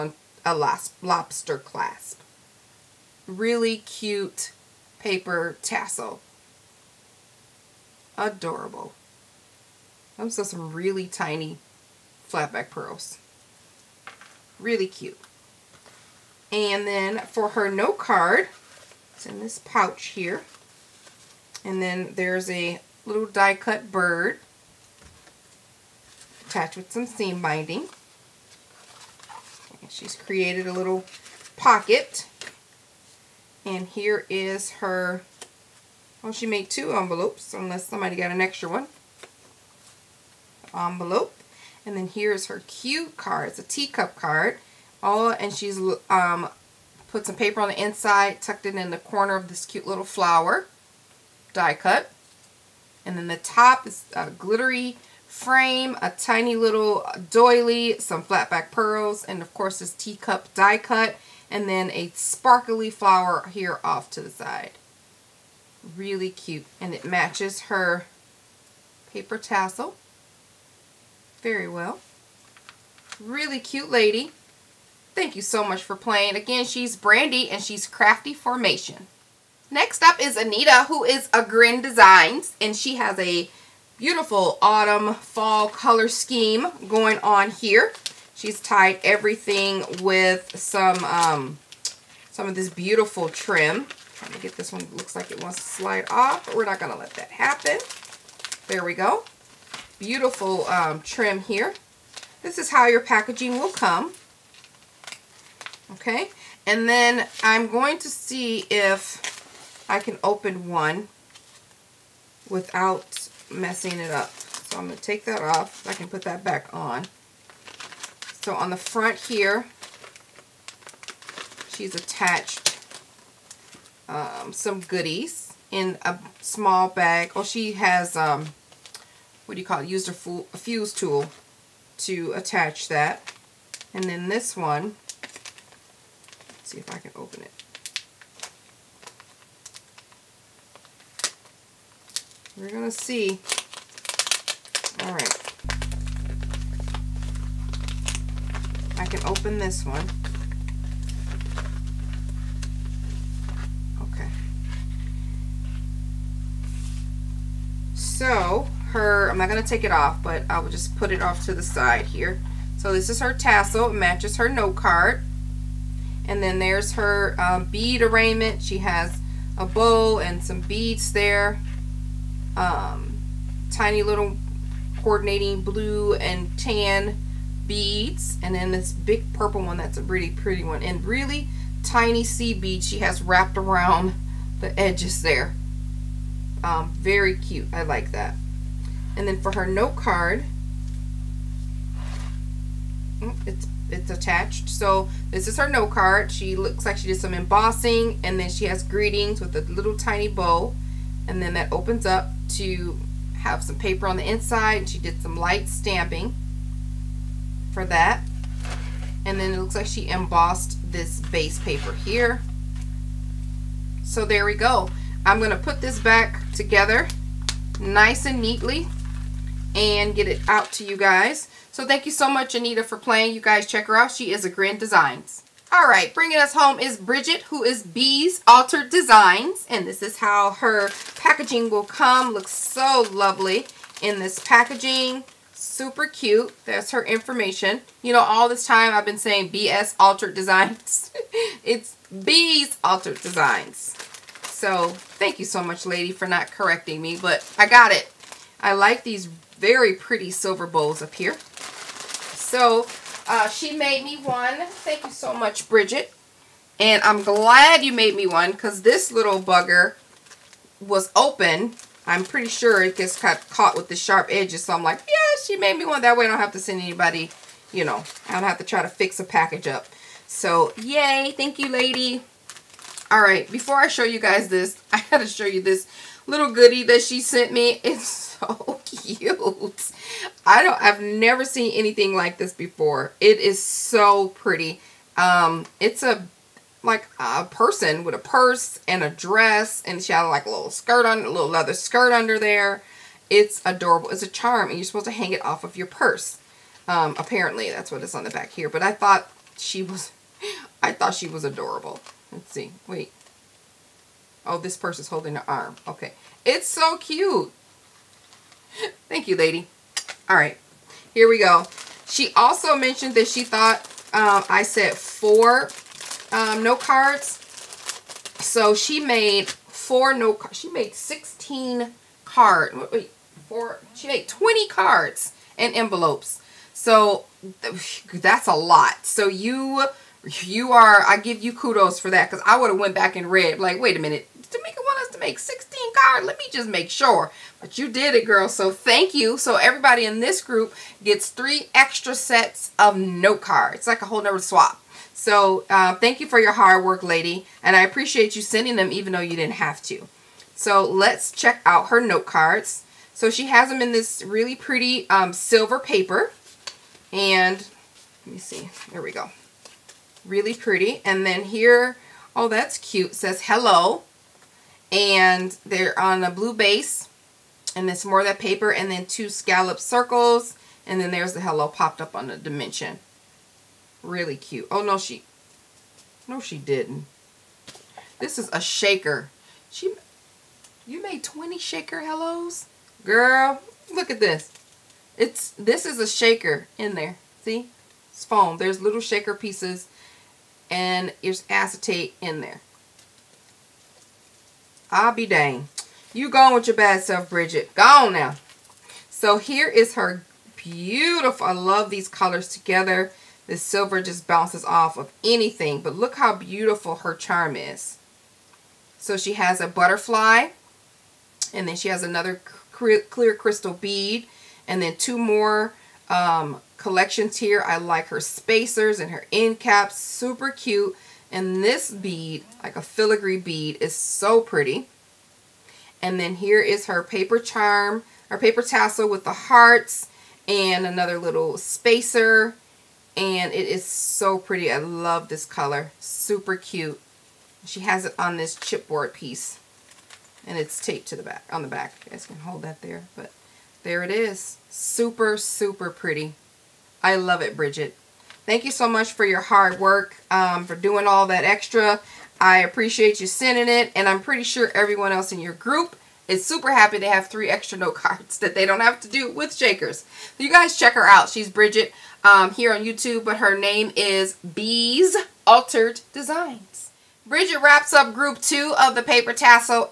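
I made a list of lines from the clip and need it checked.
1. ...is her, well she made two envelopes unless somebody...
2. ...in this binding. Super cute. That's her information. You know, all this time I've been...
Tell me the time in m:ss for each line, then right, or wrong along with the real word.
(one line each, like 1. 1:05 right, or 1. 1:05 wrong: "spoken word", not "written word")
1. 0:34 right
2. 3:54 wrong: "packaging", not "binding".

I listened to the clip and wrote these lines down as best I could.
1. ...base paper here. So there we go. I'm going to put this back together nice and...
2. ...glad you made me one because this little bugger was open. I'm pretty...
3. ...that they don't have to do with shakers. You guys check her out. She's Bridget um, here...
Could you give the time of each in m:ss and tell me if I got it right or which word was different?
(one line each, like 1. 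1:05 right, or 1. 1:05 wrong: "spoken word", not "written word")
1. 3:31 right
2. 4:17 right
3. 7:38 right.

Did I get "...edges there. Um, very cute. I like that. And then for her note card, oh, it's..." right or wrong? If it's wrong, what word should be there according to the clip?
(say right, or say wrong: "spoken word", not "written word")
right.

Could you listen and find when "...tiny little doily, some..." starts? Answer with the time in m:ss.
0:56.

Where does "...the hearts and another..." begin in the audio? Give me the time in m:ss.
7:09.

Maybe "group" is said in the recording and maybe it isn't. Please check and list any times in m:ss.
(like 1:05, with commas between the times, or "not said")
5:40, 7:35, 7:48.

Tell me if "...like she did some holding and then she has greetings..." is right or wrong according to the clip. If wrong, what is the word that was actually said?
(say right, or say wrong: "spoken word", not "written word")
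wrong: "embossing", not "holding".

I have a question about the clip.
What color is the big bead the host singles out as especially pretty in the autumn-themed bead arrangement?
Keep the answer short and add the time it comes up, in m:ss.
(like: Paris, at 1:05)
Purple, at 2:59.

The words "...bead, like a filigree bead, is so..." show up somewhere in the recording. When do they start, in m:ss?
7:01.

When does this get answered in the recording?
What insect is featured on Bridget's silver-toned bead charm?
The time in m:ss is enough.
6:49.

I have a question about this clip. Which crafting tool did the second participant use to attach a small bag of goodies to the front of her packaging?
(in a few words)
Fuse tool.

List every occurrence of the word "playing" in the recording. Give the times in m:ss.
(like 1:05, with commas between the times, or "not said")
1:15, 3:42.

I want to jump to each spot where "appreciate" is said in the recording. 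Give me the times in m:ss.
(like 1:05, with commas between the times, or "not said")
5:47, 7:32.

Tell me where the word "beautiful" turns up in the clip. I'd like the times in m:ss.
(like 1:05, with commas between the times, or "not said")
1:23, 1:32, 1:39, 6:40, 6:46.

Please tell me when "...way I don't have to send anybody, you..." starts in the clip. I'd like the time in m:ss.
4:26.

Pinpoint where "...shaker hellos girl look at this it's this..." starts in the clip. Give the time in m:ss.
6:21.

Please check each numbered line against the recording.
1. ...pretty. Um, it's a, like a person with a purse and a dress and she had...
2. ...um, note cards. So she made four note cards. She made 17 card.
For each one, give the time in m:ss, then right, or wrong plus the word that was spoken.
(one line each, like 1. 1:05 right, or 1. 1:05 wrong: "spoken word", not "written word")
1. 4:44 right
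2. 5:16 wrong: "16", not "17".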